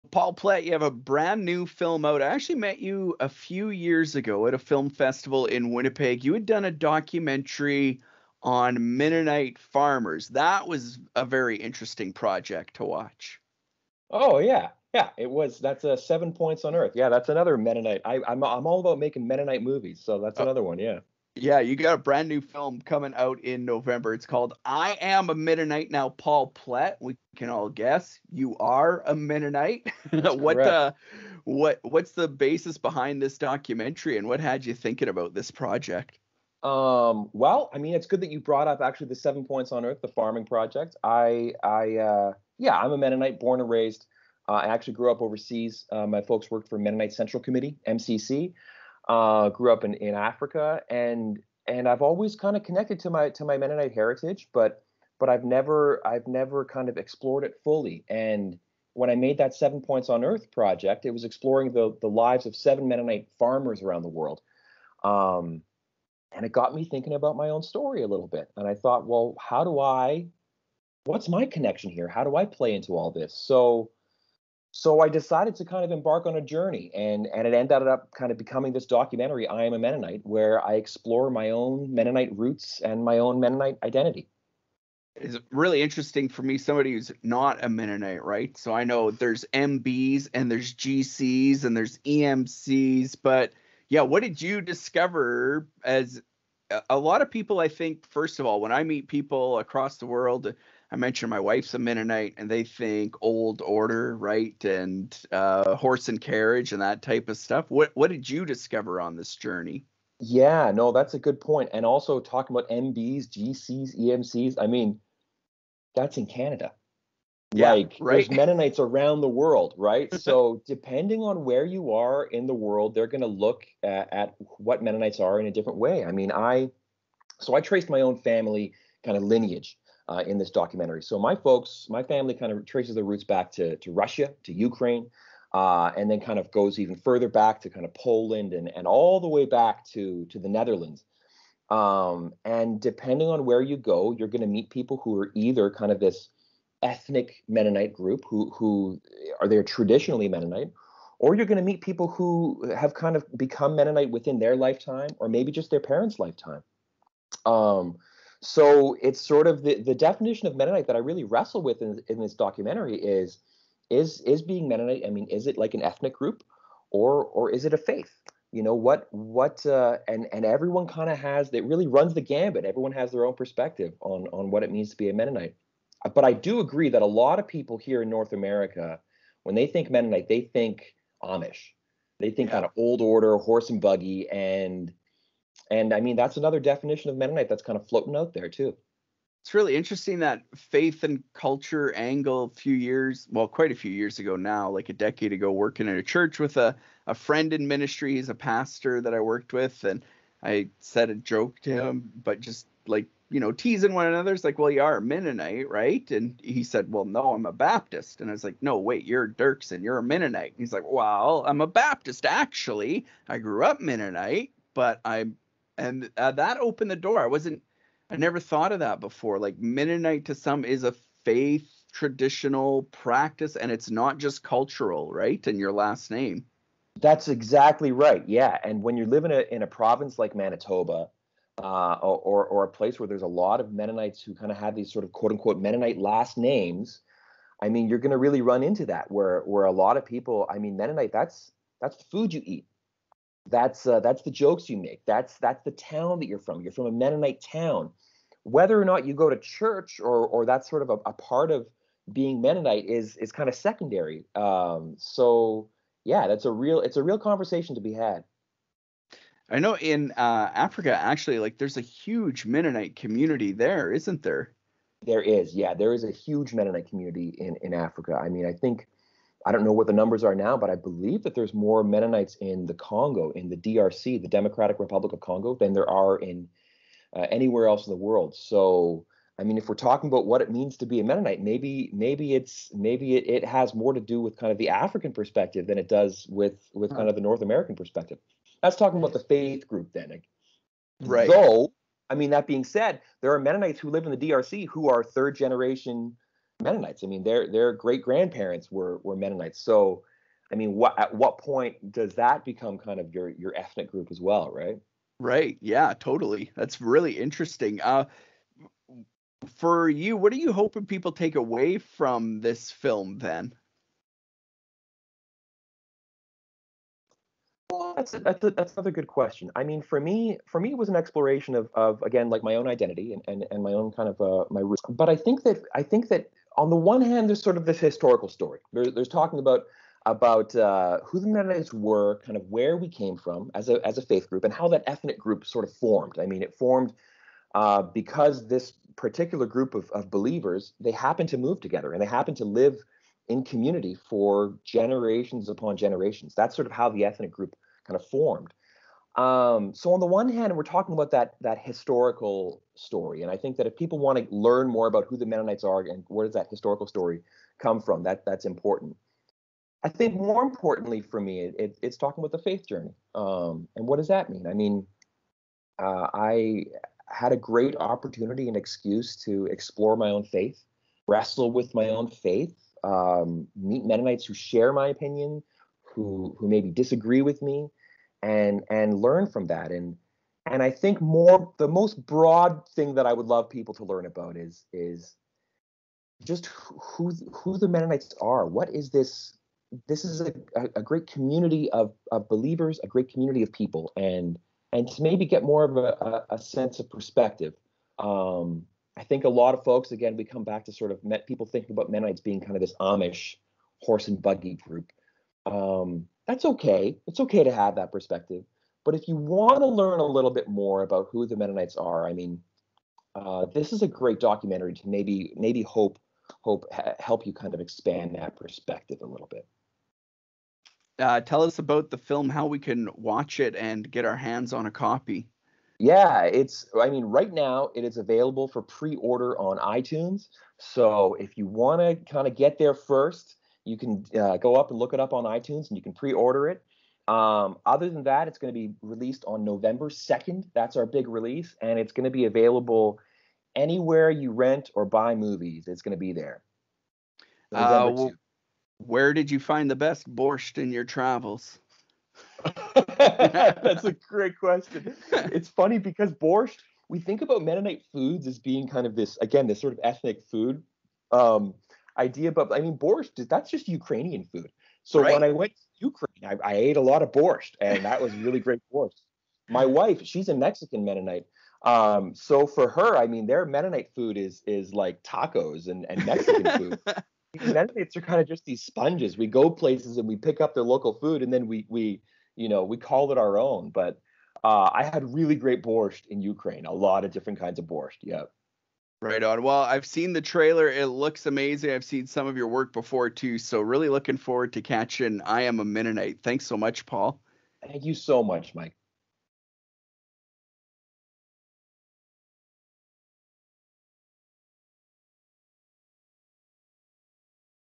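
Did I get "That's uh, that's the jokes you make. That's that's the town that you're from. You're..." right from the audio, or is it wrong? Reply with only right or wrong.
right.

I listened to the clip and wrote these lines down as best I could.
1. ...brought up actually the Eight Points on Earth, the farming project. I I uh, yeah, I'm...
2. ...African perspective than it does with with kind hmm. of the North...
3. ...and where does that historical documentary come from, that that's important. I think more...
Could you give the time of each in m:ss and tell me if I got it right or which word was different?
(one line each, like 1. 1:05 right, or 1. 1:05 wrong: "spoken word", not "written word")
1. 0:38 wrong: "Seven", not "Eight"
2. 4:44 right
3. 5:55 wrong: "story", not "documentary".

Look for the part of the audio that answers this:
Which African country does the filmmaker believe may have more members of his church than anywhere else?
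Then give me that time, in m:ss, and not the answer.
4:34.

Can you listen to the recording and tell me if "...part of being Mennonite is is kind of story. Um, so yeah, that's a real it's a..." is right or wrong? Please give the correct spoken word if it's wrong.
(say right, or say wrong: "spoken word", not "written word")
wrong: "secondary", not "story".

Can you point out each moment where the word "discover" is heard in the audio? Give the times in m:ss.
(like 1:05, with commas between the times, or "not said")
1:34, 1:48.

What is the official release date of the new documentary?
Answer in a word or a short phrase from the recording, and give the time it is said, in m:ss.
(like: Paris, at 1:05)
November 2nd, at 7:19.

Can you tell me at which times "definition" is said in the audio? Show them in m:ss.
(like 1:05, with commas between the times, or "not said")
2:39, 3:06.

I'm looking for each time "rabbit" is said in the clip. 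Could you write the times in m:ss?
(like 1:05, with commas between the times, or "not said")
not said.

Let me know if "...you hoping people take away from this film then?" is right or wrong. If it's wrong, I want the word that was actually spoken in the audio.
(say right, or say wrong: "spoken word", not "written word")
right.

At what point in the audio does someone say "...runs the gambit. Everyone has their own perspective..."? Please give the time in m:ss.
2:51.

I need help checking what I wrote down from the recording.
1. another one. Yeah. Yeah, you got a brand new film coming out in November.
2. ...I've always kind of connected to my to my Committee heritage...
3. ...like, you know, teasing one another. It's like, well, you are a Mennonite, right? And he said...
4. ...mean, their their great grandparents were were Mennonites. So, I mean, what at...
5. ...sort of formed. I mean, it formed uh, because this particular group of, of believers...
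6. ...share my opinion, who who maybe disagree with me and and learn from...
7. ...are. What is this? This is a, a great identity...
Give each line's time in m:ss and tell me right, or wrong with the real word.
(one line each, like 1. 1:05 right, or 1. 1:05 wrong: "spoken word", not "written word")
1. 0:20 right
2. 0:51 wrong: "Mennonite", not "Committee"
3. 3:22 right
4. 4:57 right
5. 5:35 right
6. 6:14 right
7. 6:28 wrong: "community", not "identity".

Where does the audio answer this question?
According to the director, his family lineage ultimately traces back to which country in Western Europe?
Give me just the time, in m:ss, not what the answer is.
2:20.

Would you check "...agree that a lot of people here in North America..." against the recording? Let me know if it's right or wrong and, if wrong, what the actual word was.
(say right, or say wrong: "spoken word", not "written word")
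right.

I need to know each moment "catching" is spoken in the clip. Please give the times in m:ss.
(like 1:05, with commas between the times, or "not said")
8:14.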